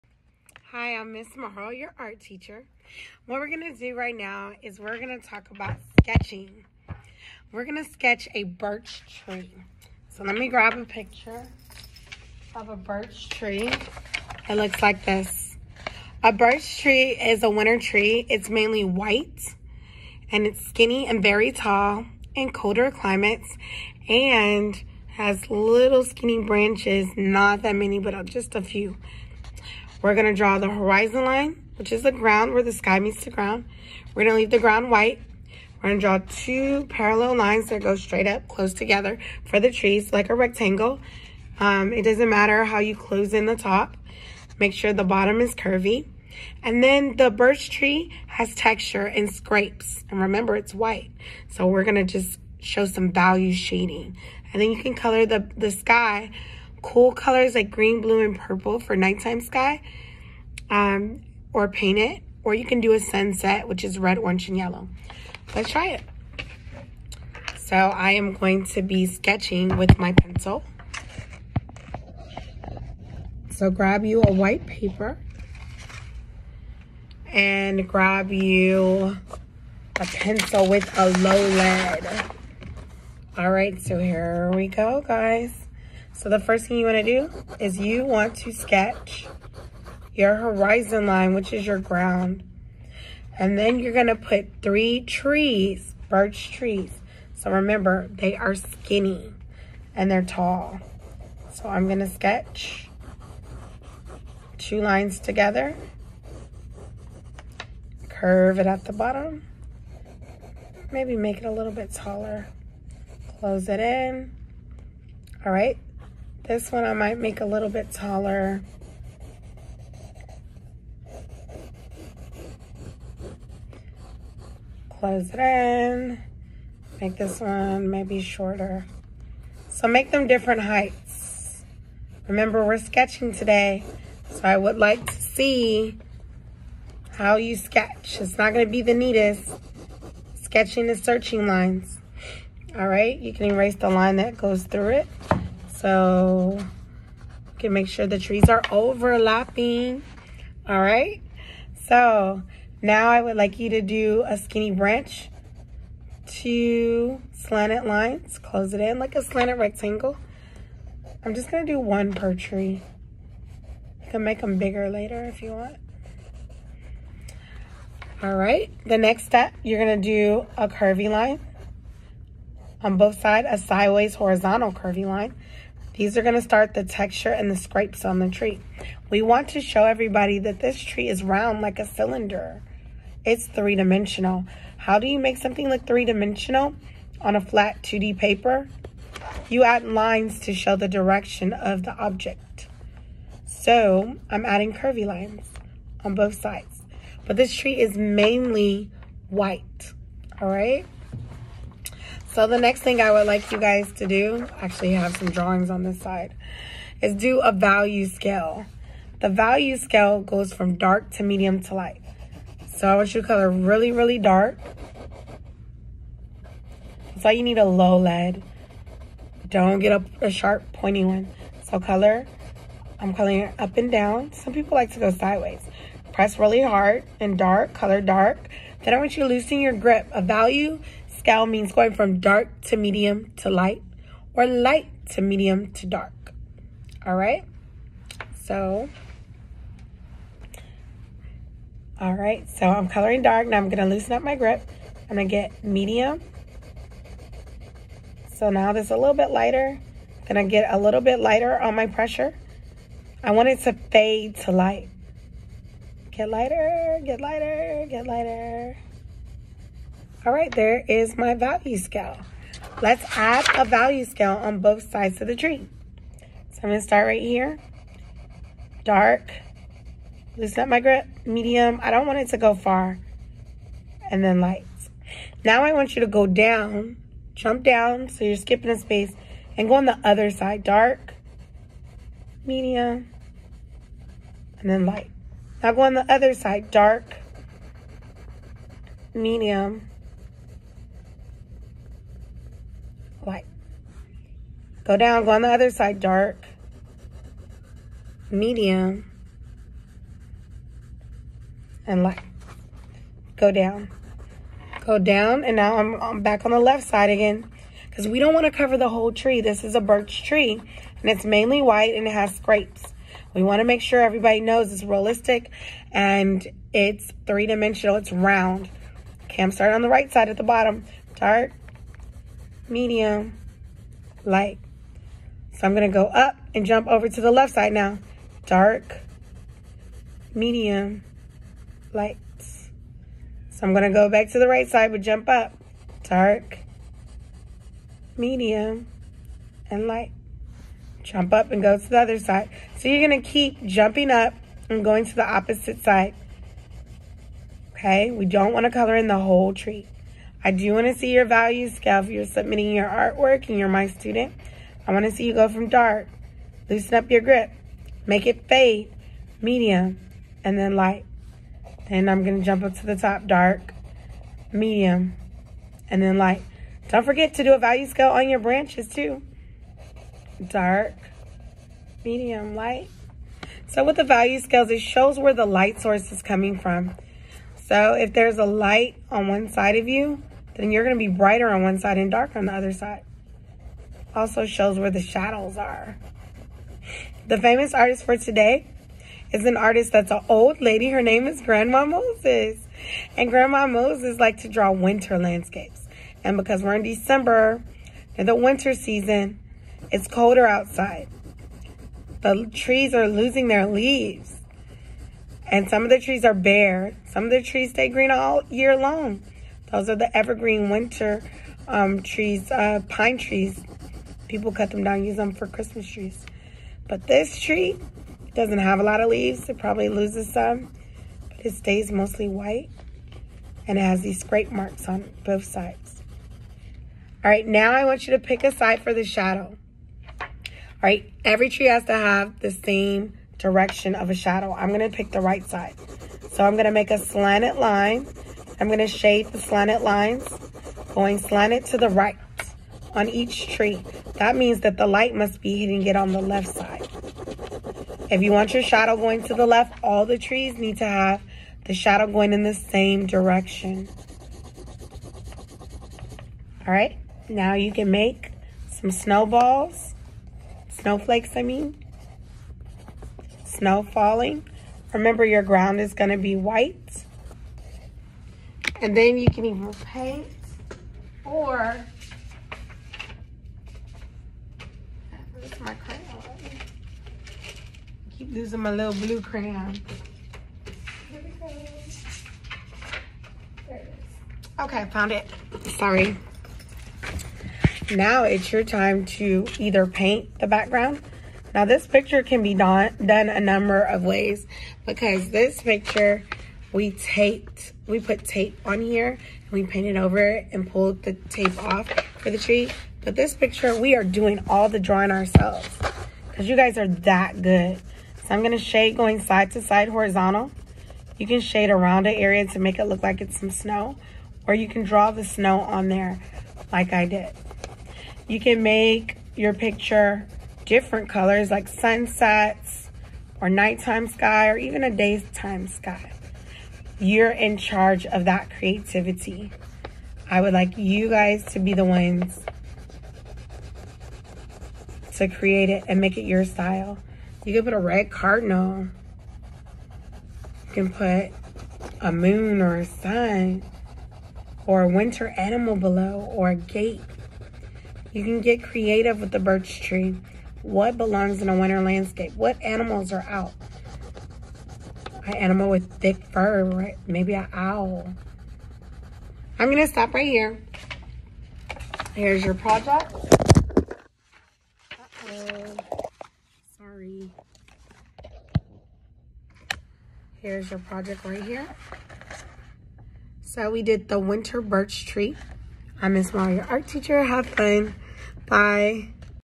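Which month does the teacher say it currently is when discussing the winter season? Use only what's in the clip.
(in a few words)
December.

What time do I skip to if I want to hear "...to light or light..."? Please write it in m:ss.
3:53.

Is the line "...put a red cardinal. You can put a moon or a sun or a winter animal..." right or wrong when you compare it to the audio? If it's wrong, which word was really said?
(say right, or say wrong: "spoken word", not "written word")
right.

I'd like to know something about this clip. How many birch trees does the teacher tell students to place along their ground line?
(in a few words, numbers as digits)
3.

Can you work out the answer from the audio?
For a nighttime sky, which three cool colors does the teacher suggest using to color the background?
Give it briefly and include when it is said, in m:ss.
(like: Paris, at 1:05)
Green, blue, and purple, at 0:57.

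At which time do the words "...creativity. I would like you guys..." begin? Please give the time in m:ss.
8:48.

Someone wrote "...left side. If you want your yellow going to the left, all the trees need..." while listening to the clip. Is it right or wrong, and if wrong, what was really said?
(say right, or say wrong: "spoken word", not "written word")
wrong: "shadow", not "yellow".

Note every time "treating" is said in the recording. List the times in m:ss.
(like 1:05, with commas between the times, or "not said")
not said.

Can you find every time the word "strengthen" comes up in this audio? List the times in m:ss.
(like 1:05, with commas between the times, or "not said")
not said.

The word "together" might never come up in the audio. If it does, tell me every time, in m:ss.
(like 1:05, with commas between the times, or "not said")
0:38, 1:45.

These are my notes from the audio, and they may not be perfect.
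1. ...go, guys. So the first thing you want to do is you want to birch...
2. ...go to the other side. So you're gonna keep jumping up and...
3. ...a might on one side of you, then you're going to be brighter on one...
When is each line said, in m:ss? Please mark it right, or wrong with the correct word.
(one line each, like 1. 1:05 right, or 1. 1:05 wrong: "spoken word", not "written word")
1. 1:24 wrong: "sketch", not "birch"
2. 5:41 right
3. 6:18 wrong: "light", not "might".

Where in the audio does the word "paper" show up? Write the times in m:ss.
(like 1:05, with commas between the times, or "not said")
1:14, 3:08.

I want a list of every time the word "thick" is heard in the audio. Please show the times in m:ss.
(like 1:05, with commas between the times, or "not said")
9:15.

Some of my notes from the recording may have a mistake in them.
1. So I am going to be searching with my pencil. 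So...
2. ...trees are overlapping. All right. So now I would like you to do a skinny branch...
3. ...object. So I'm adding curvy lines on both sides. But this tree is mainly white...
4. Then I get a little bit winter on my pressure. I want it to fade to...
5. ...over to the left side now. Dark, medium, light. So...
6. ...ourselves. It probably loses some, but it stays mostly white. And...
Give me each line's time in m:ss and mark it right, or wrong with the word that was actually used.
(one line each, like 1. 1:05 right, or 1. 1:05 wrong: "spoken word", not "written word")
1. 1:07 wrong: "sketching", not "searching"
2. 2:28 right
3. 3:11 right
4. 4:10 wrong: "lighter", not "winter"
5. 5:26 right
6. 6:59 wrong: "leaves", not "ourselves".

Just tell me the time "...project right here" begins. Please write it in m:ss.
9:30.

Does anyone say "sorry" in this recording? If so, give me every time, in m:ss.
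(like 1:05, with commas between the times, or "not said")
8:05, 9:26.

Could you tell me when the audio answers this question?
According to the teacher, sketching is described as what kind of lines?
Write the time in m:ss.
2:21.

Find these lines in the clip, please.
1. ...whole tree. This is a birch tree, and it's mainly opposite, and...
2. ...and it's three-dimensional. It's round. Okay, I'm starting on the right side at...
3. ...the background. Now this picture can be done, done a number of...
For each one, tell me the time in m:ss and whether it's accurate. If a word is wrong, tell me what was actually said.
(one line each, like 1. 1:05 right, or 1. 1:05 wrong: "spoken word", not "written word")
1. 5:08 wrong: "white", not "opposite"
2. 5:15 right
3. 8:10 right.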